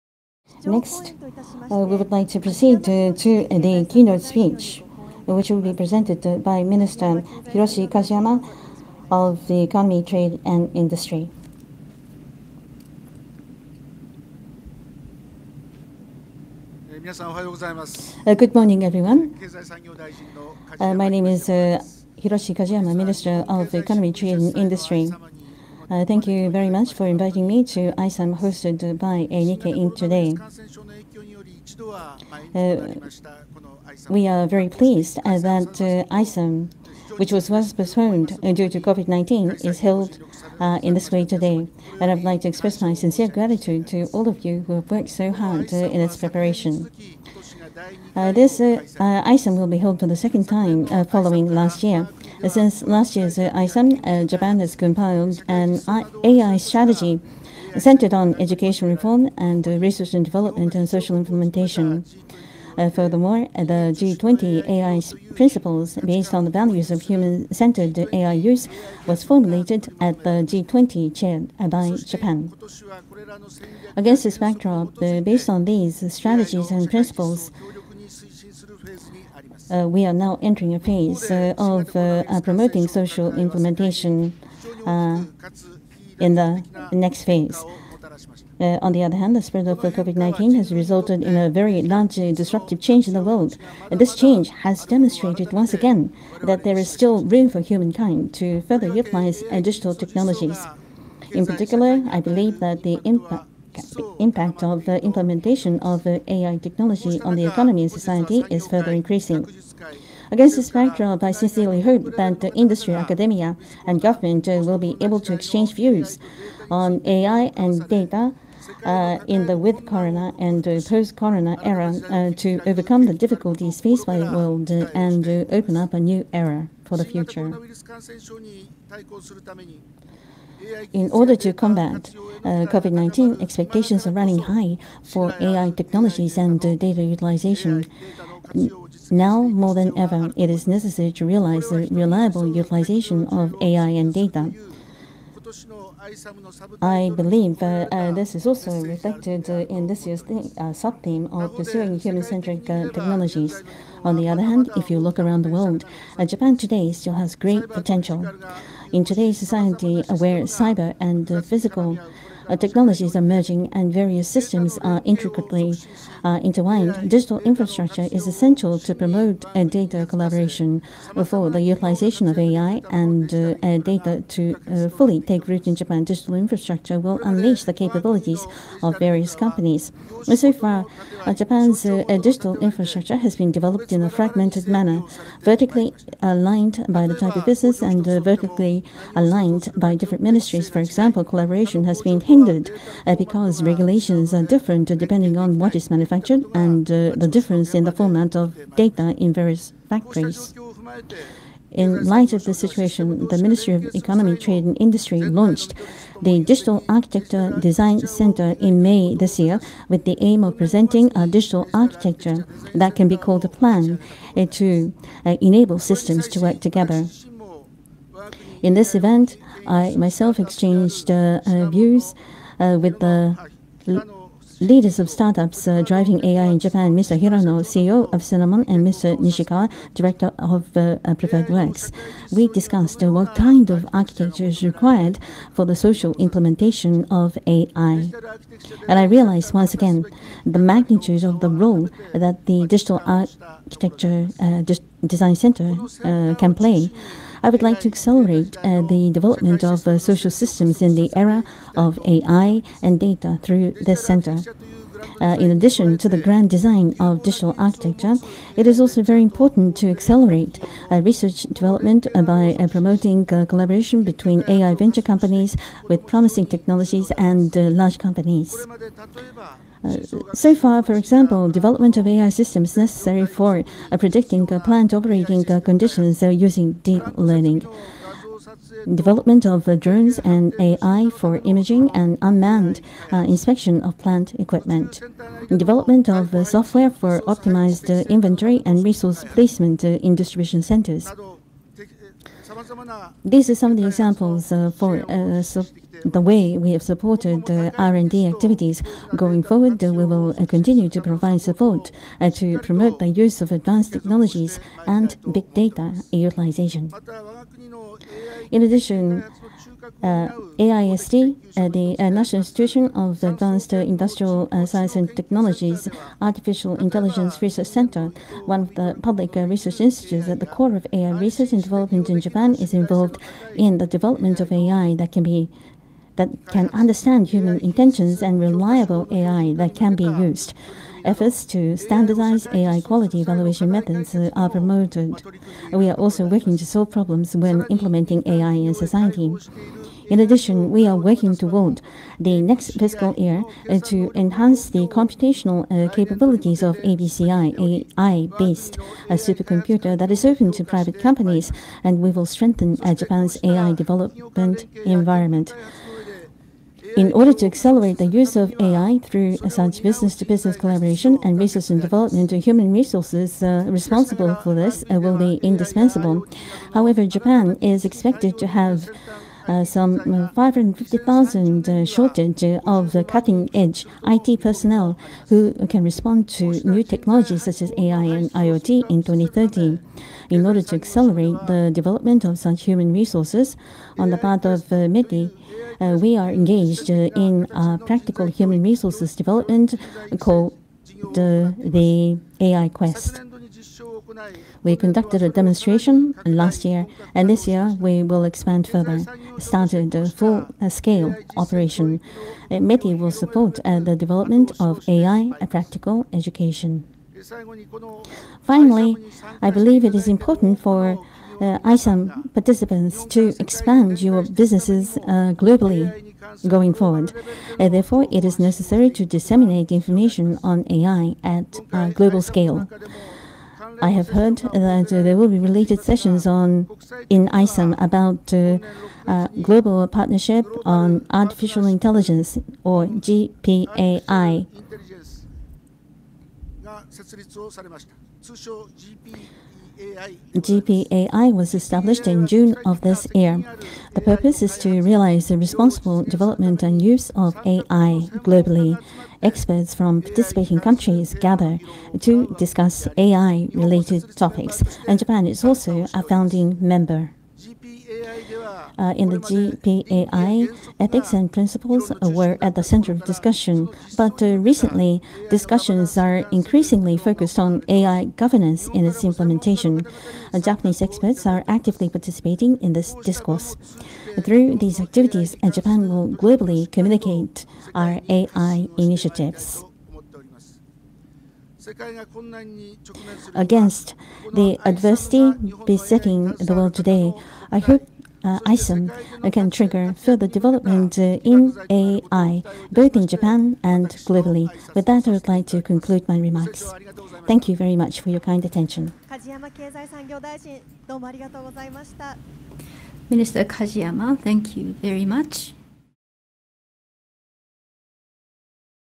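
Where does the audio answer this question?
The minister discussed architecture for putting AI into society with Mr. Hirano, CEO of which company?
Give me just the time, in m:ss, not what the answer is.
3:48.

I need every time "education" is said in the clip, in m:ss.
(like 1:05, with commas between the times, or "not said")
0:58, 6:46.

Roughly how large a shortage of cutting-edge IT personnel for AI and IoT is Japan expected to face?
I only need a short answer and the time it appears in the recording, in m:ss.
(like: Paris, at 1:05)
550,000, at 6:10.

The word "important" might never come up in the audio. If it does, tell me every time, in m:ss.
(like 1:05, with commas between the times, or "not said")
4:19, 6:50.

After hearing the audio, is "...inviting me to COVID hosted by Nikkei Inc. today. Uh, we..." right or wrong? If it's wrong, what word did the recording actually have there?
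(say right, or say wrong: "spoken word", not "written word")
wrong: "AISUM", not "COVID".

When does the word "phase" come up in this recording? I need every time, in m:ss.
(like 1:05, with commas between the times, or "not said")
1:20, 1:27.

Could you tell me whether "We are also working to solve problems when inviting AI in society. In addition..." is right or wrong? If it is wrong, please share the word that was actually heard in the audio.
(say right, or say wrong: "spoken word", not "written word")
wrong: "implementing", not "inviting".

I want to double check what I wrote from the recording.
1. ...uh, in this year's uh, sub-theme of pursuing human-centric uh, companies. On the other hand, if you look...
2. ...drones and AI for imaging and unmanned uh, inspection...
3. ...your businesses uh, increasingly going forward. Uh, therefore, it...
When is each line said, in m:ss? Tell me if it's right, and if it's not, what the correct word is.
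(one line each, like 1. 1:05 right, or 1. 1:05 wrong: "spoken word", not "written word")
1. 2:29 wrong: "technologies", not "companies"
2. 4:39 right
3. 6:54 wrong: "globally", not "increasingly".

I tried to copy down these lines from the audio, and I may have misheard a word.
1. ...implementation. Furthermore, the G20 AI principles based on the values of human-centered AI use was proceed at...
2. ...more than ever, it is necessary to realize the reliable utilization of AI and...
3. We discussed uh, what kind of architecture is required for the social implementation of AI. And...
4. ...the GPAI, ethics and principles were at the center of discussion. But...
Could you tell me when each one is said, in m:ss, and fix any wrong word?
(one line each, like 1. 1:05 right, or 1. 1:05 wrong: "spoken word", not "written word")
1. 1:01 wrong: "formulated", not "proceed"
2. 2:19 right
3. 3:52 right
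4. 7:39 right.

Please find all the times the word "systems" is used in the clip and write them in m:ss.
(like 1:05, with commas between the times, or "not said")
2:44, 3:35, 4:10, 4:32.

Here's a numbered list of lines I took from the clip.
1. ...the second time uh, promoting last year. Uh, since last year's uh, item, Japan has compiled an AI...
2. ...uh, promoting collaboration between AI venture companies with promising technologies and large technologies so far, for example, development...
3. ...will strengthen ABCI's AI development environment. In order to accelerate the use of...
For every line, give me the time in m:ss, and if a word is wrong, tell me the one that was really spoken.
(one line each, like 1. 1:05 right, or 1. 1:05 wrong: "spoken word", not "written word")
1. 0:50 wrong: "following", not "promoting"
2. 4:22 wrong: "companies", not "technologies"
3. 5:52 wrong: "Japan", not "ABCI".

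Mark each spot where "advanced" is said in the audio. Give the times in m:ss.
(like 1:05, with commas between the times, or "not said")
5:03, 5:13.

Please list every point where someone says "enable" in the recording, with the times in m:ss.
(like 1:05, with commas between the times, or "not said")
3:35.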